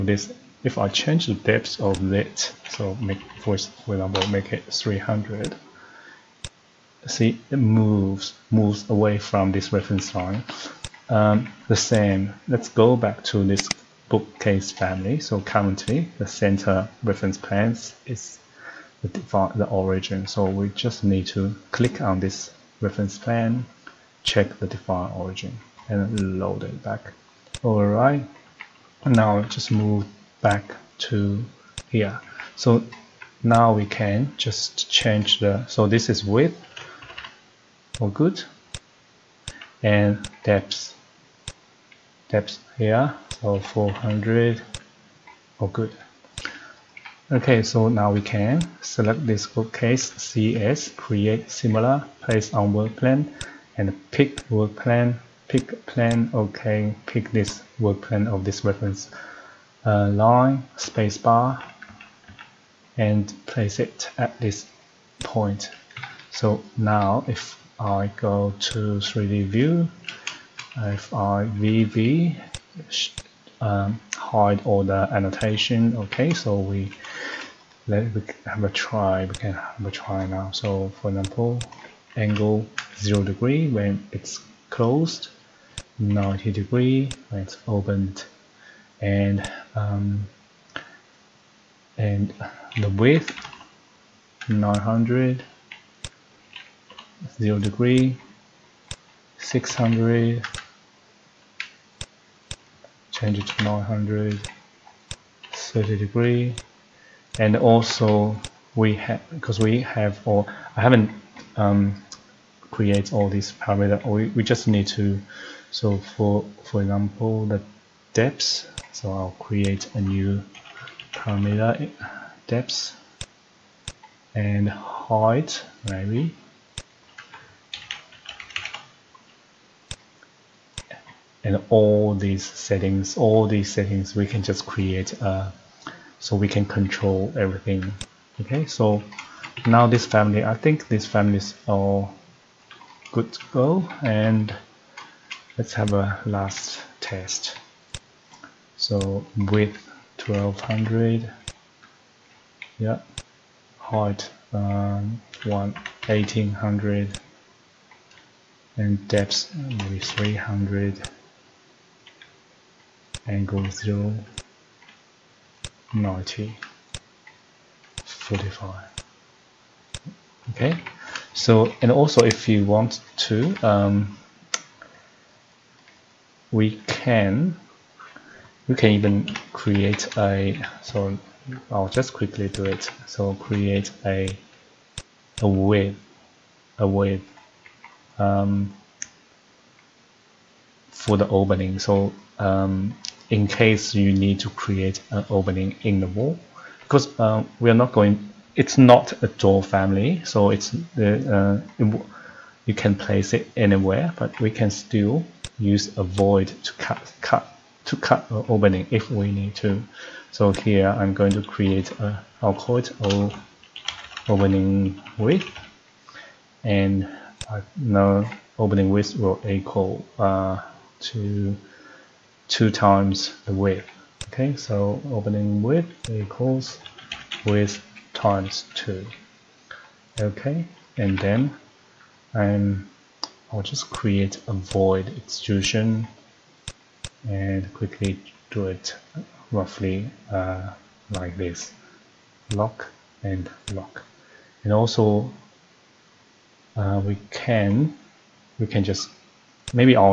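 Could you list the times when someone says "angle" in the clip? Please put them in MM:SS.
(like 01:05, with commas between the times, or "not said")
01:22, 02:43.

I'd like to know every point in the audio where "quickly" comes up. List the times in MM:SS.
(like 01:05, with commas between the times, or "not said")
03:02, 03:57.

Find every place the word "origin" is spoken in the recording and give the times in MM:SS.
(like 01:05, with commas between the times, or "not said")
00:19, 00:25.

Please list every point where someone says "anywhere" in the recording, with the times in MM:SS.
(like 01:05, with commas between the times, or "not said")
03:23.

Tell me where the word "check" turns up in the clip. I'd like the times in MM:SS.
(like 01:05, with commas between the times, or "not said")
00:24.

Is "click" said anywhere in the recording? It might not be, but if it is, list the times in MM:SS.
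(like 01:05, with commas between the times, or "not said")
00:21.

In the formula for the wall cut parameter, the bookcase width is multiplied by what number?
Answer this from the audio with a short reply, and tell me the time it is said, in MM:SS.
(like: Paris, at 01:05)
2, at 03:48.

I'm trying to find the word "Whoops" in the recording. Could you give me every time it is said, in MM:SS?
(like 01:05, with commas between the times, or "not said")
not said.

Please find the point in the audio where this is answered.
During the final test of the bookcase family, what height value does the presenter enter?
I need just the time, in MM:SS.
02:35.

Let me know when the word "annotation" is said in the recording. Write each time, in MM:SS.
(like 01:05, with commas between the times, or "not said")
01:15.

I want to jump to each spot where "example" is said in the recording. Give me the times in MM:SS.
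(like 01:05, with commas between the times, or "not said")
00:03, 01:21, 01:56.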